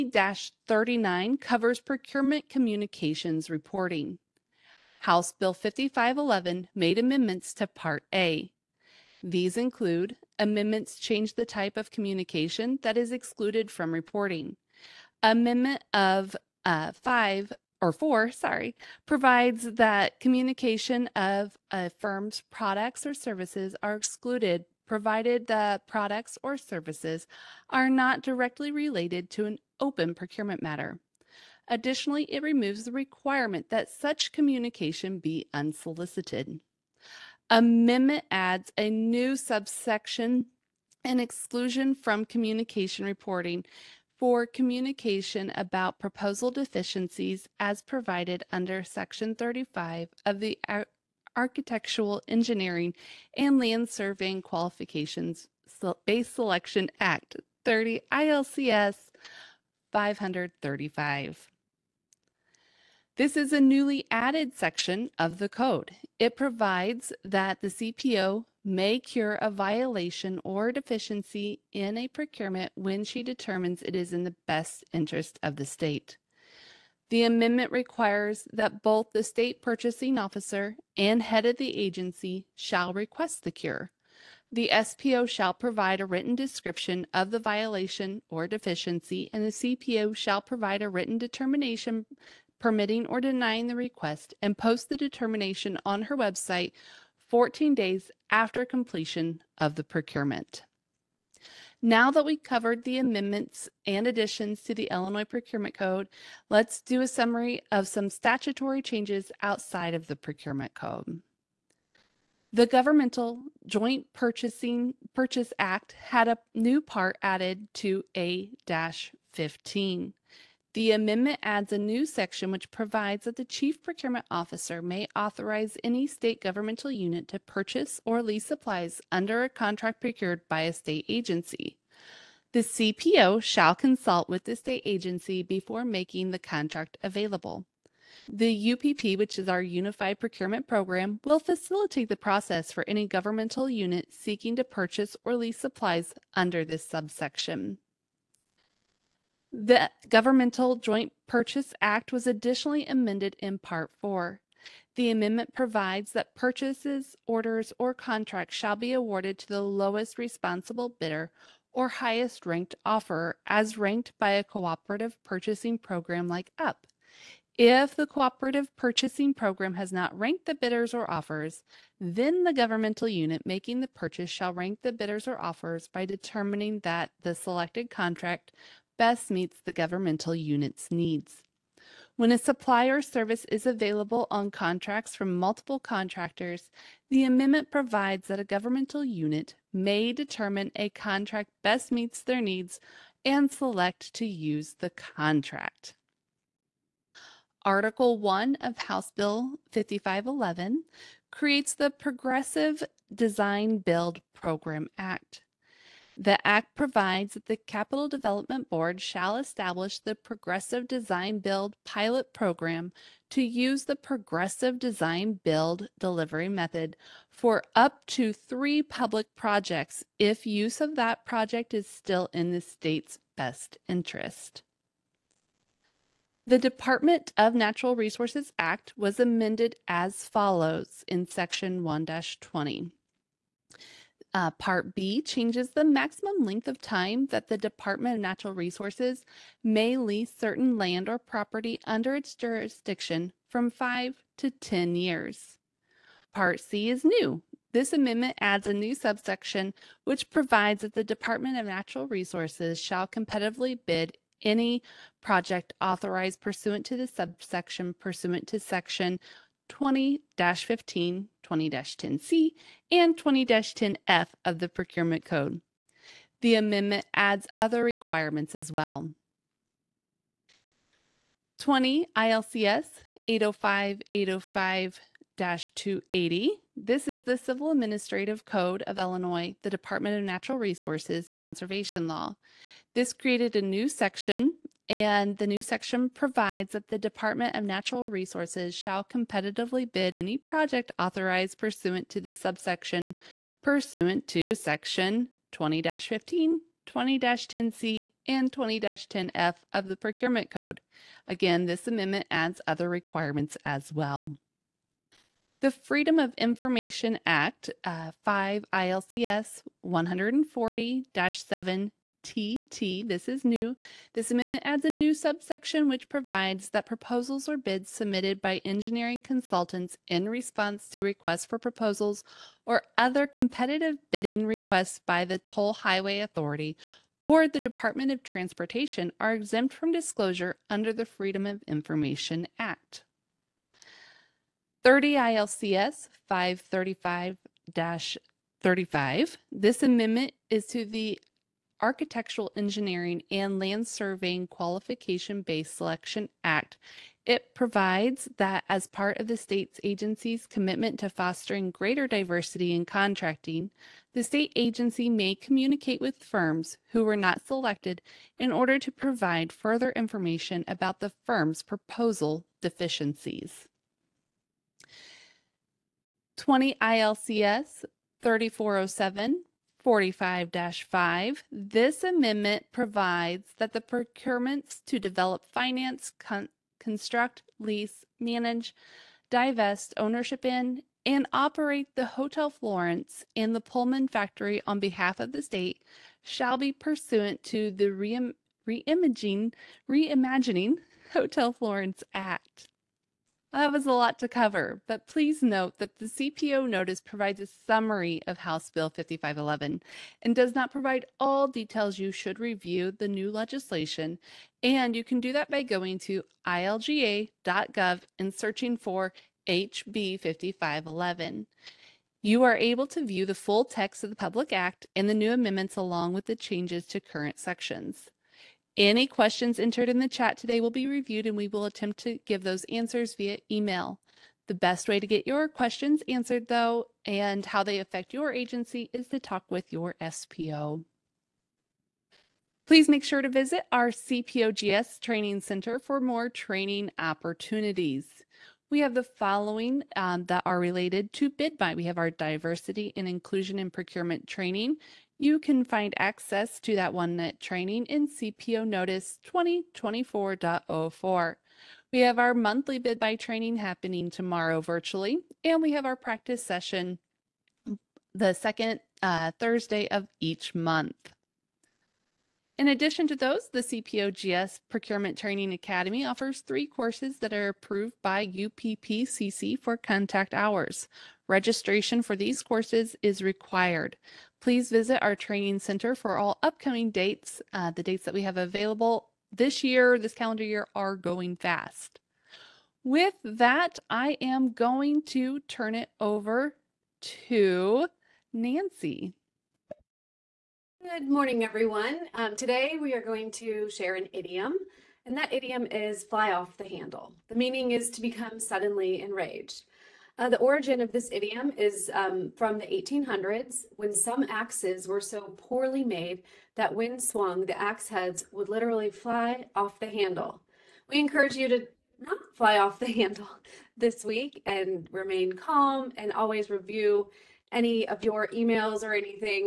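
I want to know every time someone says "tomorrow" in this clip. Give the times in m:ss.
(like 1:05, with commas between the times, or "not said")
7:34.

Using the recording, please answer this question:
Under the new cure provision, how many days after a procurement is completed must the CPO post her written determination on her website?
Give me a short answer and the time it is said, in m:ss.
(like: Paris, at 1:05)
14 days, at 1:37.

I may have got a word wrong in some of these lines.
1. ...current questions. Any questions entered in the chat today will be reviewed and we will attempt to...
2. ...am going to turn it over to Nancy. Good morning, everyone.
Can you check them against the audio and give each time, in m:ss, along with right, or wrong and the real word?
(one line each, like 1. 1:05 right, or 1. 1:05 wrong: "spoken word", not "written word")
1. 6:57 wrong: "sections", not "questions"
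2. 8:04 right.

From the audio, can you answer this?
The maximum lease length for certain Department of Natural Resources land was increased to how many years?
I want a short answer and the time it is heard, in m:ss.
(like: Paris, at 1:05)
10 years, at 4:04.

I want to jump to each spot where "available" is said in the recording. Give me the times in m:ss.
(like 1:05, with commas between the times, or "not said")
2:17, 3:03, 7:58.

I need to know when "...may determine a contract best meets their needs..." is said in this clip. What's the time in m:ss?
3:09.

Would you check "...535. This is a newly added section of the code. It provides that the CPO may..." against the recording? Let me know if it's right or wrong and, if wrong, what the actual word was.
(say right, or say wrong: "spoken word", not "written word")
right.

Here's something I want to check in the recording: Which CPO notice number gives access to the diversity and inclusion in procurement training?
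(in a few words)
2024.04.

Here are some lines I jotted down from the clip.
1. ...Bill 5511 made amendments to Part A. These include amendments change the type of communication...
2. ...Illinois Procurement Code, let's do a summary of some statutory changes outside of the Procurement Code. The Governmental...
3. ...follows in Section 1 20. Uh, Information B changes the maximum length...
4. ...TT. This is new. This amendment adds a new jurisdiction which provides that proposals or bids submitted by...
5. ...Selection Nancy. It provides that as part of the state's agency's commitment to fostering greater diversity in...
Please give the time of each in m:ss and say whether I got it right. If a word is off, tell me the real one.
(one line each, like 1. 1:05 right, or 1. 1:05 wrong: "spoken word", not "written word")
1. 0:05 right
2. 1:44 right
3. 3:50 wrong: "Part", not "Information"
4. 5:12 wrong: "subsection", not "jurisdiction"
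5. 5:45 wrong: "Act", not "Nancy".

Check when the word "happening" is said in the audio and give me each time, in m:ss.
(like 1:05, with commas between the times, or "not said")
7:33.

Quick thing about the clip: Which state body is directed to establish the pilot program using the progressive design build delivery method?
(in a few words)
Capital Development Board.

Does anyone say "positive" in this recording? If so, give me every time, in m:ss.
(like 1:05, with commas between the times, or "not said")
not said.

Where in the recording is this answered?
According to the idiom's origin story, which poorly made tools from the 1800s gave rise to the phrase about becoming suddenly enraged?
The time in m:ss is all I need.
8:24.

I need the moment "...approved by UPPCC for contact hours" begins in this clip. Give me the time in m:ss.
7:47.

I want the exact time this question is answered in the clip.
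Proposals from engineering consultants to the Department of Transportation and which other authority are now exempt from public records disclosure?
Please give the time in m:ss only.
5:25.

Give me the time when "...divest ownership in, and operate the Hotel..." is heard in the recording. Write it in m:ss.
6:19.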